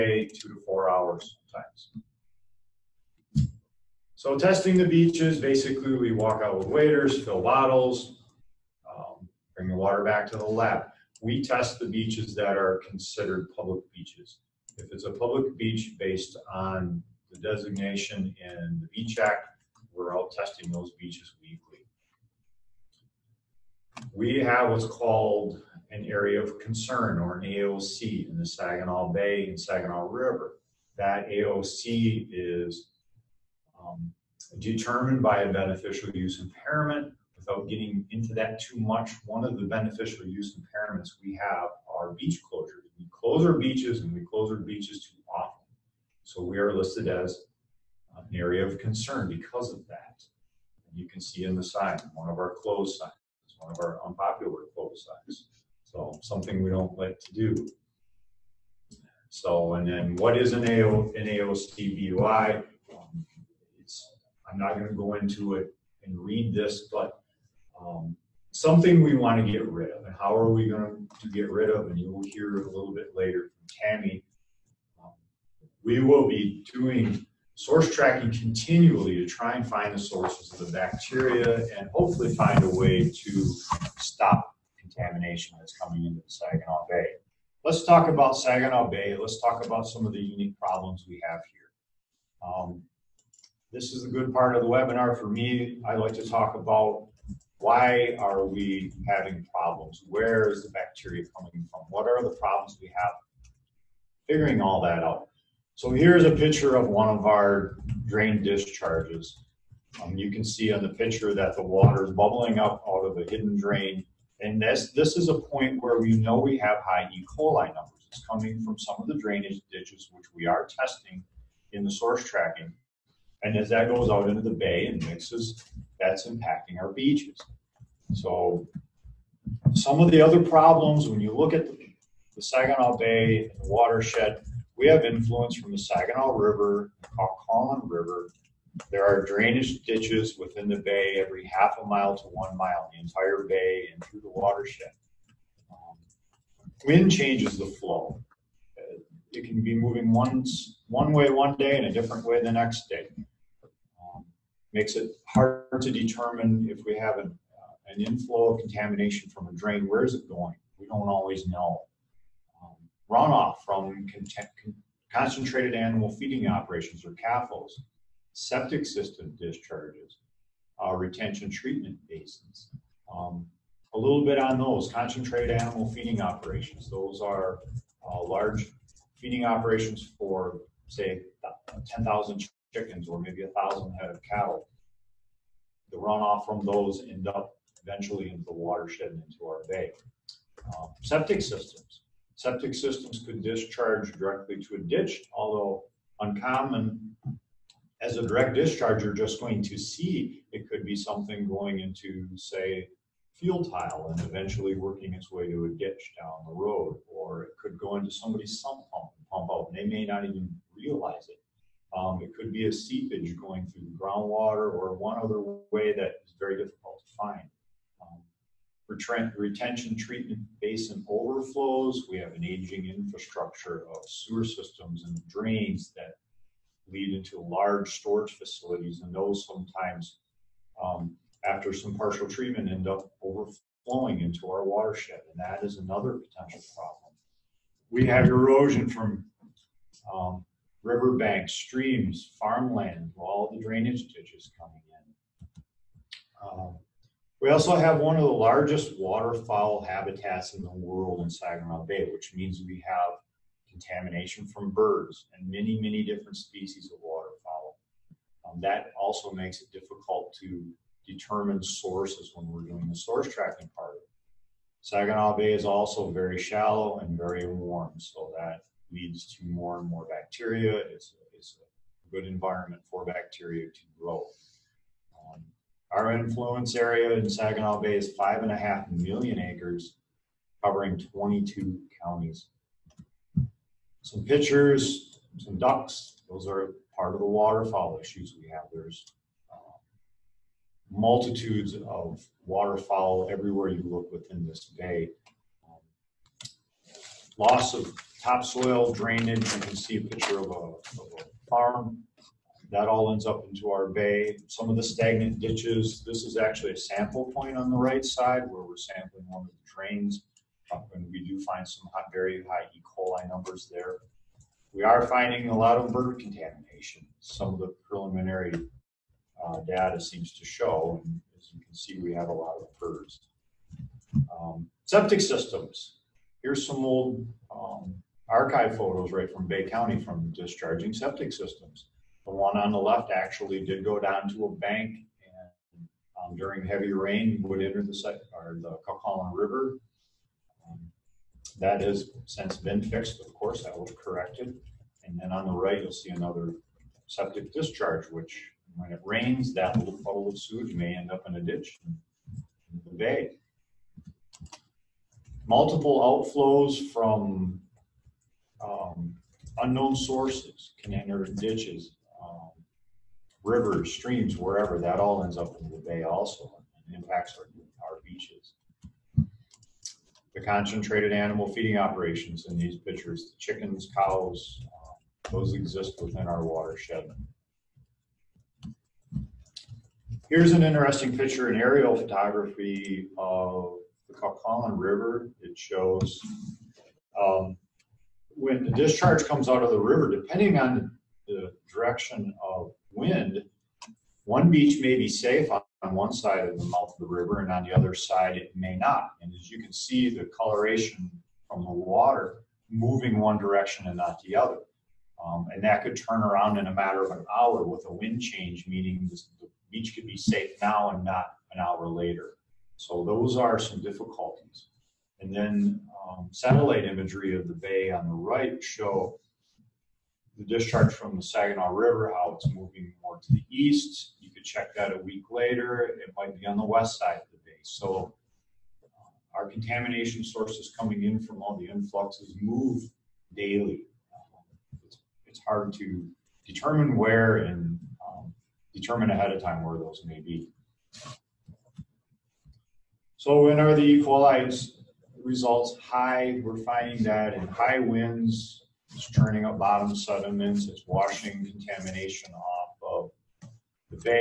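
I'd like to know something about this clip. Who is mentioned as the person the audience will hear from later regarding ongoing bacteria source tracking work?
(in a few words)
Tami.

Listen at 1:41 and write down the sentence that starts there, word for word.
What are the problems we have?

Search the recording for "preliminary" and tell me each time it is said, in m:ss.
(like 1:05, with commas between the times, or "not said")
5:17.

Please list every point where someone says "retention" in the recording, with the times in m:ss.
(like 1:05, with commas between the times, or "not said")
2:50, 3:39.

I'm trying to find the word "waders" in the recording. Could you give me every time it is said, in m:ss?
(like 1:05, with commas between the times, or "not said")
0:06.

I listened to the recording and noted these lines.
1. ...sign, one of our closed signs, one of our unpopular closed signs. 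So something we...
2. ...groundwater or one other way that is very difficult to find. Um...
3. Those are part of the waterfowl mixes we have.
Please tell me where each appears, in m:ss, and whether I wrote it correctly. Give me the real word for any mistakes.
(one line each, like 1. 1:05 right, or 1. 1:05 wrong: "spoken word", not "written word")
1. 0:51 right
2. 3:33 right
3. 4:46 wrong: "issues", not "mixes".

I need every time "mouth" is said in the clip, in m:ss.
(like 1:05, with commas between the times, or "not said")
6:36.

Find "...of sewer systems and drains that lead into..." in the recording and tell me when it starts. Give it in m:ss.
3:43.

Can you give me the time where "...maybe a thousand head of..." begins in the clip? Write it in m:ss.
3:03.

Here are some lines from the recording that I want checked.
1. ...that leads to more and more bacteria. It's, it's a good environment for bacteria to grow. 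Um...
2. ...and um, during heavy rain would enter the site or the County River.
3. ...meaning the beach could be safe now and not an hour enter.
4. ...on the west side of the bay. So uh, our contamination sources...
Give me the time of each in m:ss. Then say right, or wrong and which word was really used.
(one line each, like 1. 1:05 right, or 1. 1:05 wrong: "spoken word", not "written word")
1. 4:28 right
2. 5:35 wrong: "Kawkawlin", not "County"
3. 6:48 wrong: "later", not "enter"
4. 7:06 right.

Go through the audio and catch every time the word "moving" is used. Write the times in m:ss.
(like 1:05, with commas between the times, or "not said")
2:29, 6:42, 7:02.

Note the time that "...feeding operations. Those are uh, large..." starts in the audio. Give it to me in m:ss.
2:55.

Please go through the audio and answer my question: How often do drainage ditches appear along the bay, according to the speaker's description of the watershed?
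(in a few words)
every half a mile to one mile.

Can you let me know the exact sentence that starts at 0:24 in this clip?
We have what's called an area of concern or an AOC in the Saginaw Bay and Saginaw River.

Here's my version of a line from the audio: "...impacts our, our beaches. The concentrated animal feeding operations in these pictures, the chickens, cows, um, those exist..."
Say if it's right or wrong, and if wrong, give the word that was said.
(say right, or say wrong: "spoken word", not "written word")
right.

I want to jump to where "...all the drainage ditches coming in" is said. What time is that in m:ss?
4:03.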